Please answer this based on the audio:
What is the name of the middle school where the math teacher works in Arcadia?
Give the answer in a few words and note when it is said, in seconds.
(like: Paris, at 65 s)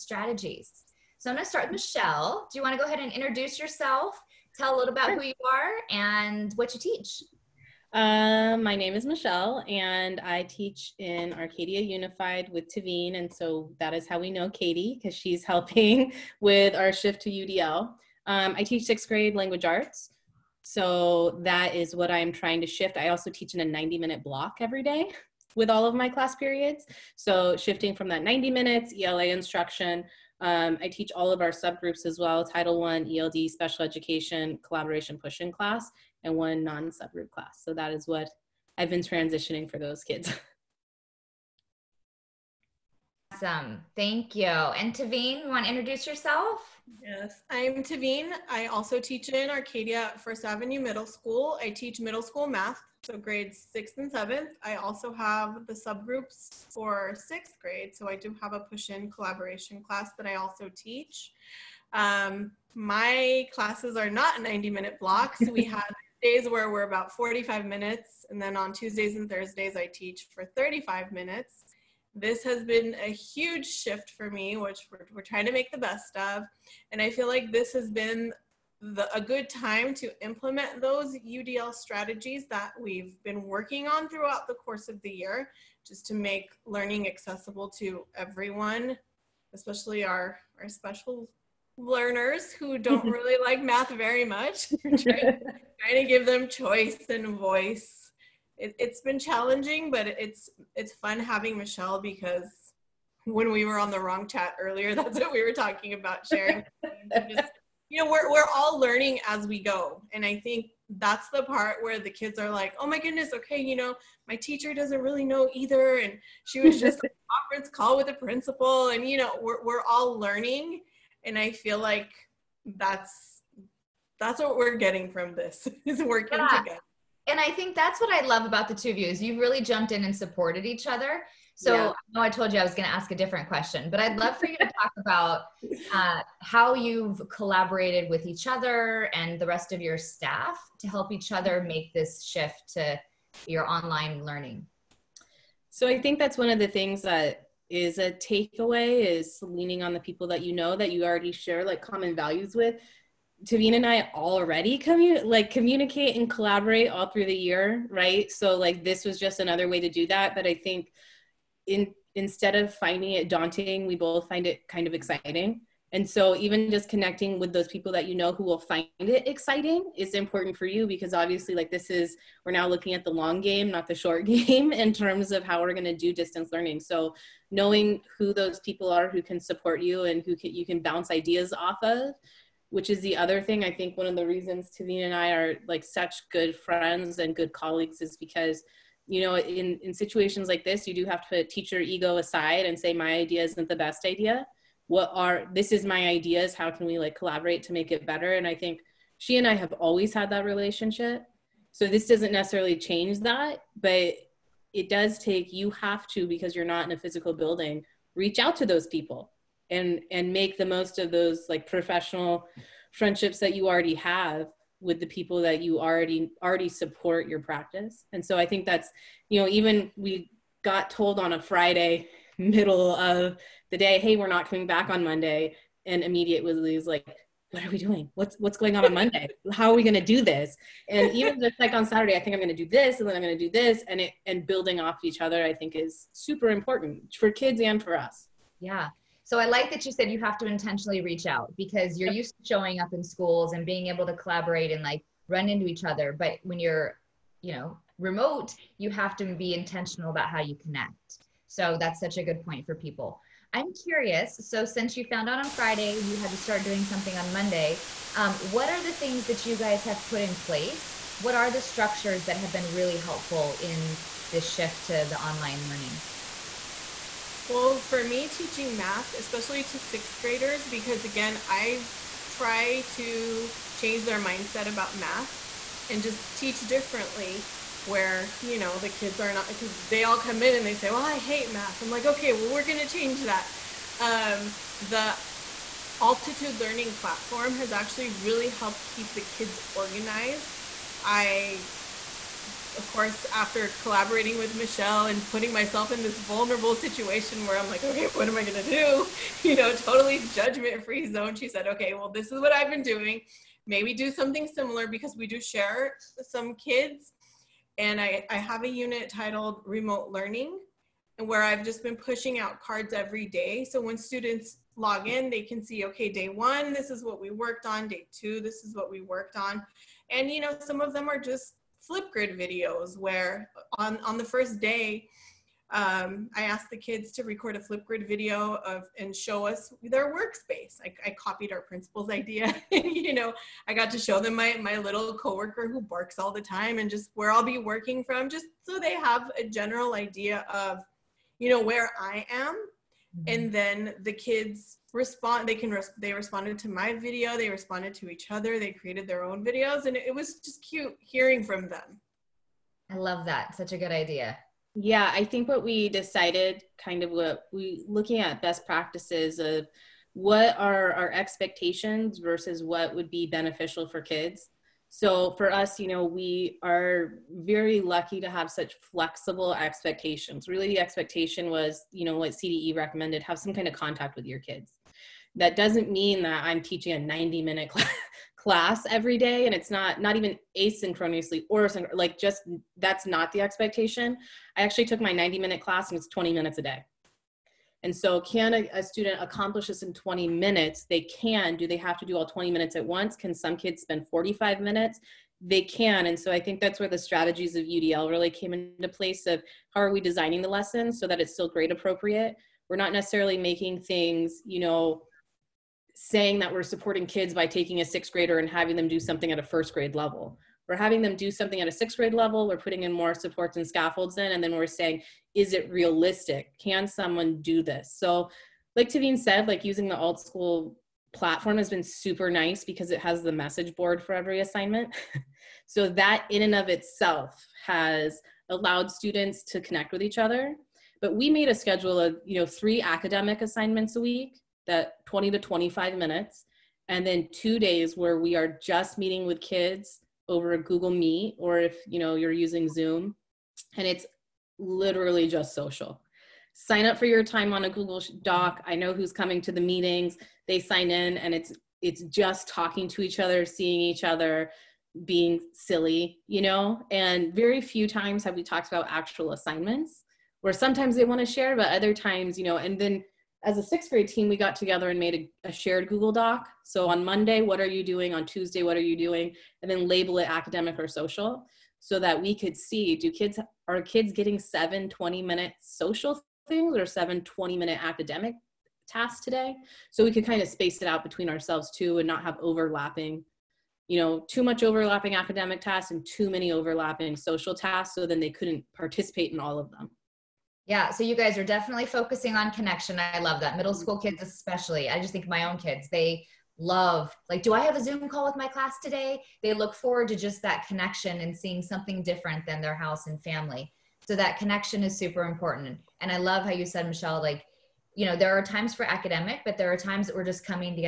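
First Avenue Middle School, at 50 s.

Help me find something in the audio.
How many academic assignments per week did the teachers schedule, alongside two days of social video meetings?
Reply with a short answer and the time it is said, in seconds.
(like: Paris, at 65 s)
3, at 432 s.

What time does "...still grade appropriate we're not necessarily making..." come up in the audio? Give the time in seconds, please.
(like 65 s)
401 s.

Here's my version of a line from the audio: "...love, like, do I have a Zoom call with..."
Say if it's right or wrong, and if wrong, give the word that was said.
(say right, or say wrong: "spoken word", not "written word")
right.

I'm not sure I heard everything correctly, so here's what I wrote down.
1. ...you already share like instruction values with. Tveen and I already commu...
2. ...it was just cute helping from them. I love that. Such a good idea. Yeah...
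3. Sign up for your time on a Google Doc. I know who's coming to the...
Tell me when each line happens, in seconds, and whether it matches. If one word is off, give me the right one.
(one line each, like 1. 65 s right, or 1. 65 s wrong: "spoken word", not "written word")
1. 150 s wrong: "common", not "instruction"
2. 350 s wrong: "hearing", not "helping"
3. 446 s right.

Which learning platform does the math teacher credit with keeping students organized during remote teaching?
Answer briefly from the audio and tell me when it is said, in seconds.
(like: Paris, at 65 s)
altitude, at 286 s.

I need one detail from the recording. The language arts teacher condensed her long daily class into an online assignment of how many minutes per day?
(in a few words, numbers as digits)
20 minutes.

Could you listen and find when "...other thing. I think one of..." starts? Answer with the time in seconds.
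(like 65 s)
183 s.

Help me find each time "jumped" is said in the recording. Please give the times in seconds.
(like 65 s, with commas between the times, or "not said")
129 s.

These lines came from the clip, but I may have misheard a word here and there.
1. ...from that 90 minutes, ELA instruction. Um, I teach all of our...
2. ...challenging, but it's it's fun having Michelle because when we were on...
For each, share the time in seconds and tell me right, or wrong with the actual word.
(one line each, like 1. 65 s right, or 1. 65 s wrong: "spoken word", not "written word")
1. 27 s right
2. 99 s right.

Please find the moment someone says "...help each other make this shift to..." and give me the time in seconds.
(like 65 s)
140 s.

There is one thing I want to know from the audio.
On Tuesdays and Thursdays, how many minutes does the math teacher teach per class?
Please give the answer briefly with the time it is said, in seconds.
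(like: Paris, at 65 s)
35 minutes, at 70 s.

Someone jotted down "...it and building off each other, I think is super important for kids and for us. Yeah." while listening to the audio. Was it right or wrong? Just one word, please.
right.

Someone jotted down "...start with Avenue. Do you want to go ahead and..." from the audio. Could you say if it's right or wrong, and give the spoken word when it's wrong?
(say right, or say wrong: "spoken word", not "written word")
wrong: "Michelle", not "Avenue".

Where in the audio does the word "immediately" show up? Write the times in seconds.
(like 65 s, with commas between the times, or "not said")
226 s.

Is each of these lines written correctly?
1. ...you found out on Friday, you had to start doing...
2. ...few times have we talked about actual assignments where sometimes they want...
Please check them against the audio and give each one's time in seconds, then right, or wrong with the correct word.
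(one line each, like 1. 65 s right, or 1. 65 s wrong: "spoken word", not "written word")
1. 254 s right
2. 457 s right.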